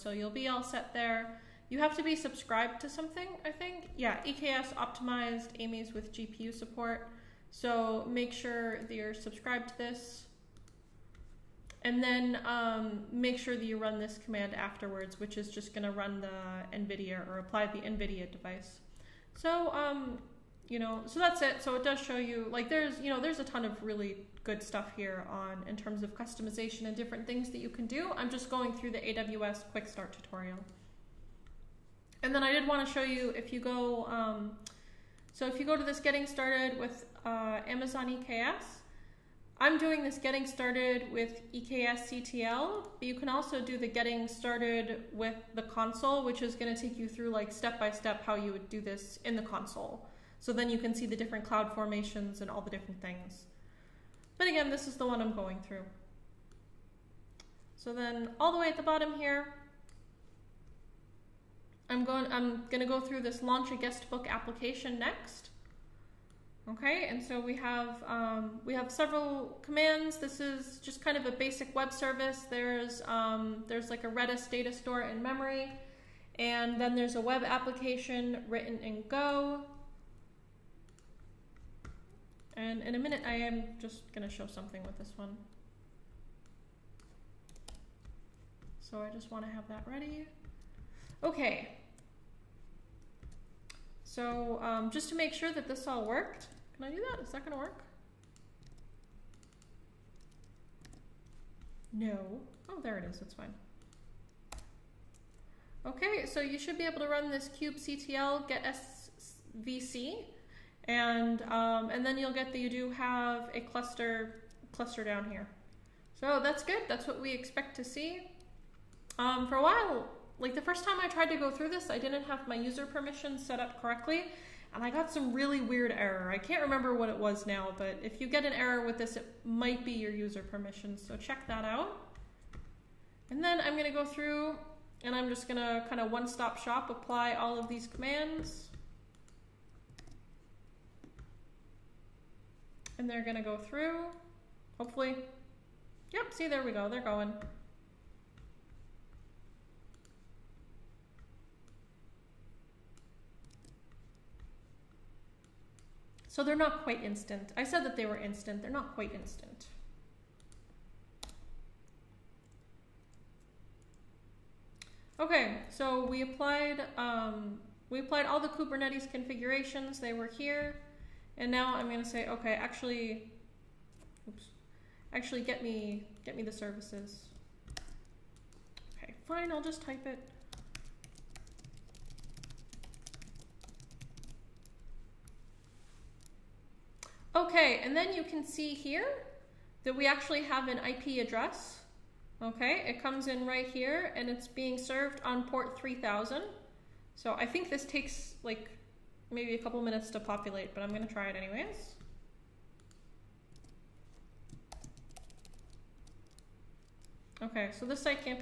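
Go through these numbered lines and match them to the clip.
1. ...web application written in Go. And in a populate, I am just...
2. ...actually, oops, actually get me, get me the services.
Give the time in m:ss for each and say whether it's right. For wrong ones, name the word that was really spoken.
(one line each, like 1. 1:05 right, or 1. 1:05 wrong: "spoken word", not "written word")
1. 1:17 wrong: "minute", not "populate"
2. 2:52 right.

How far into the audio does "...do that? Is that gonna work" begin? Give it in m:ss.
1:36.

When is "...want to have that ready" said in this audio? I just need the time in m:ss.
1:29.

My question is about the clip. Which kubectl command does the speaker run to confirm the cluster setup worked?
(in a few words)
kubectl get svc.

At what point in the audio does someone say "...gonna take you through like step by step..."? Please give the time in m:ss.
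0:46.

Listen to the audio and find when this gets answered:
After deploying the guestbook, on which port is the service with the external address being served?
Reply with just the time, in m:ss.
3:15.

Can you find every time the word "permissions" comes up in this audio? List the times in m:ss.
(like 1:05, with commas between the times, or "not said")
2:02, 2:10.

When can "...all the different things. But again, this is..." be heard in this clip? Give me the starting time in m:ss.
0:52.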